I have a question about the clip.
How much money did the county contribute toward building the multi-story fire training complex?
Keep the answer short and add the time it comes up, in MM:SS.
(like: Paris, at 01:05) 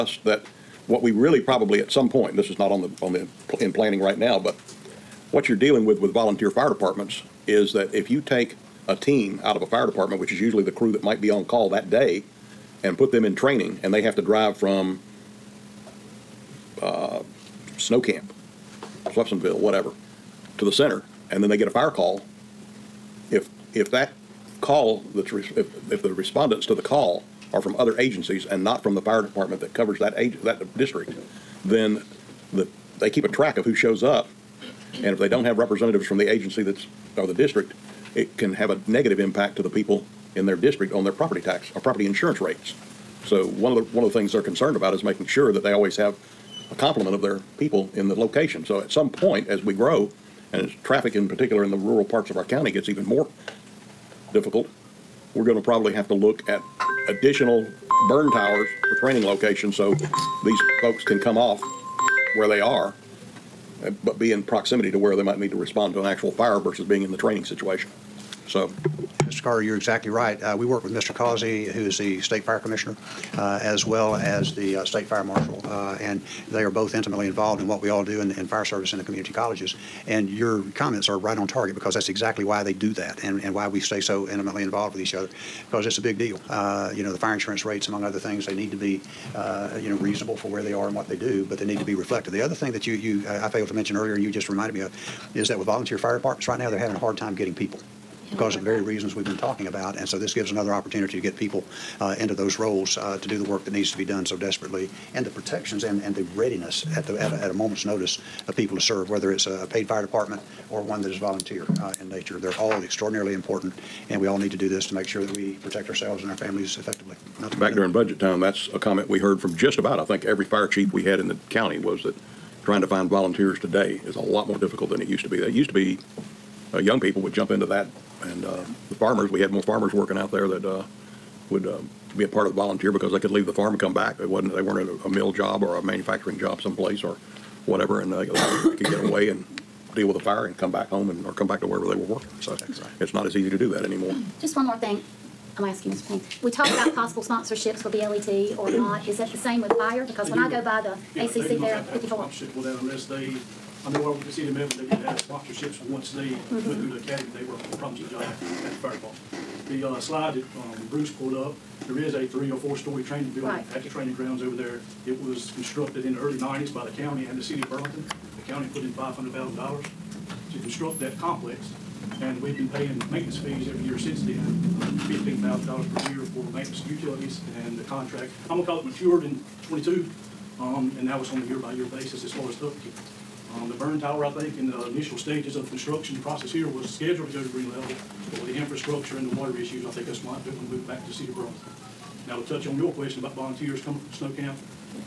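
$500,000, at 02:48.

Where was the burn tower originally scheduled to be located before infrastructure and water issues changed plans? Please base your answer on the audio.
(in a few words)
Green Level.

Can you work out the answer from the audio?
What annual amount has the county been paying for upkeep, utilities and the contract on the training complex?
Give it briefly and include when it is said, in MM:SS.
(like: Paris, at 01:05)
$15,000, at 02:55.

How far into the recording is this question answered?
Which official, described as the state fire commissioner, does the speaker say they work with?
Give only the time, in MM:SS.
01:10.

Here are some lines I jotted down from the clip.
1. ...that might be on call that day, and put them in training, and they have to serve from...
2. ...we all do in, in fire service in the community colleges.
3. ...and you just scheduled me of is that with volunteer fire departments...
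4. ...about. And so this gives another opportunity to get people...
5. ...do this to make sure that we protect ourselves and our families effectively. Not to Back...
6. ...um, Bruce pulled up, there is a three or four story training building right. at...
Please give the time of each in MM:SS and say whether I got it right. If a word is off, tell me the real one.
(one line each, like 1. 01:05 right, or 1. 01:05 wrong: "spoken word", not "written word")
1. 00:10 wrong: "drive", not "serve"
2. 01:17 right
3. 01:34 wrong: "reminded", not "scheduled"
4. 01:39 right
5. 01:54 right
6. 02:40 right.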